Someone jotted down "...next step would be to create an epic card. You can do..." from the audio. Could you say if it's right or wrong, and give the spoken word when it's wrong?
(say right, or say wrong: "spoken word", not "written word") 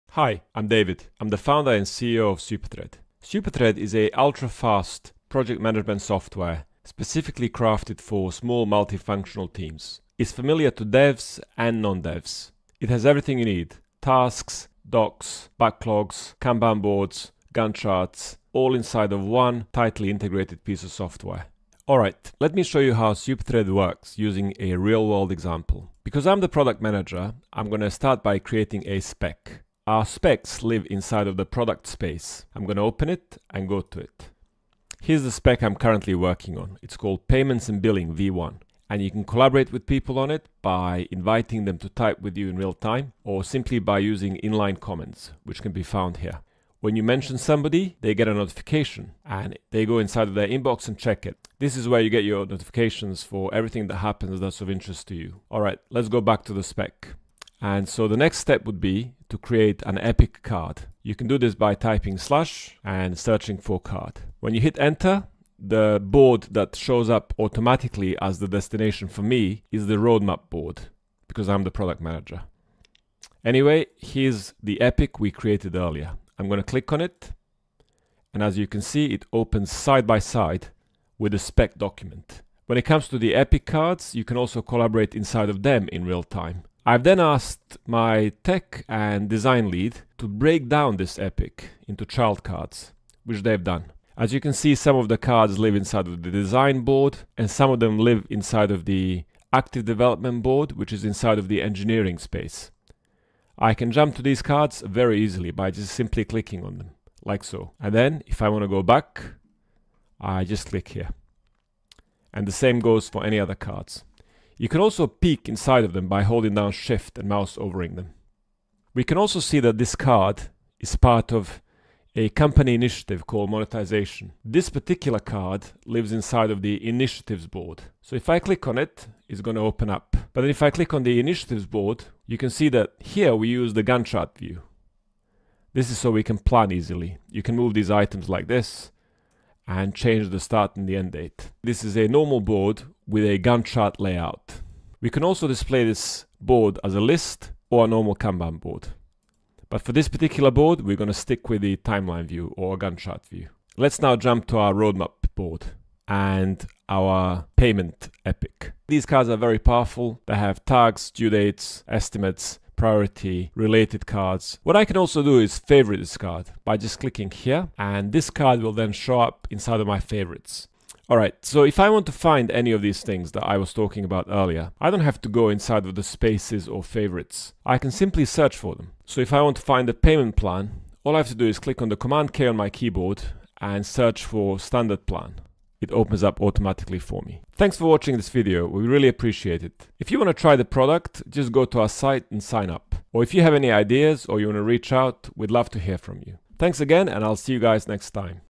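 right.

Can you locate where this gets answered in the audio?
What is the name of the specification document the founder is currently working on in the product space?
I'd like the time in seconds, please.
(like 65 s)
37 s.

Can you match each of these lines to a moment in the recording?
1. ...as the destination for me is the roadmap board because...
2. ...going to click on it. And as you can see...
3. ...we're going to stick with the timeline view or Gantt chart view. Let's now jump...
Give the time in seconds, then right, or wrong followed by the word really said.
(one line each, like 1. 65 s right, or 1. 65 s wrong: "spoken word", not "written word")
1. 68 s right
2. 76 s right
3. 150 s right.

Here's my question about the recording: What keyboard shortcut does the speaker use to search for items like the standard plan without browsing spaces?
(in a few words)
Command K.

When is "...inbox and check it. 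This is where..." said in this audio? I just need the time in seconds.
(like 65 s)
50 s.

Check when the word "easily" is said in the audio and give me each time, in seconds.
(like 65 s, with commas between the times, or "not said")
105 s, 136 s.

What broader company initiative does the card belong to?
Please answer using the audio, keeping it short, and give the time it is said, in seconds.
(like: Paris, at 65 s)
Monetization, at 123 s.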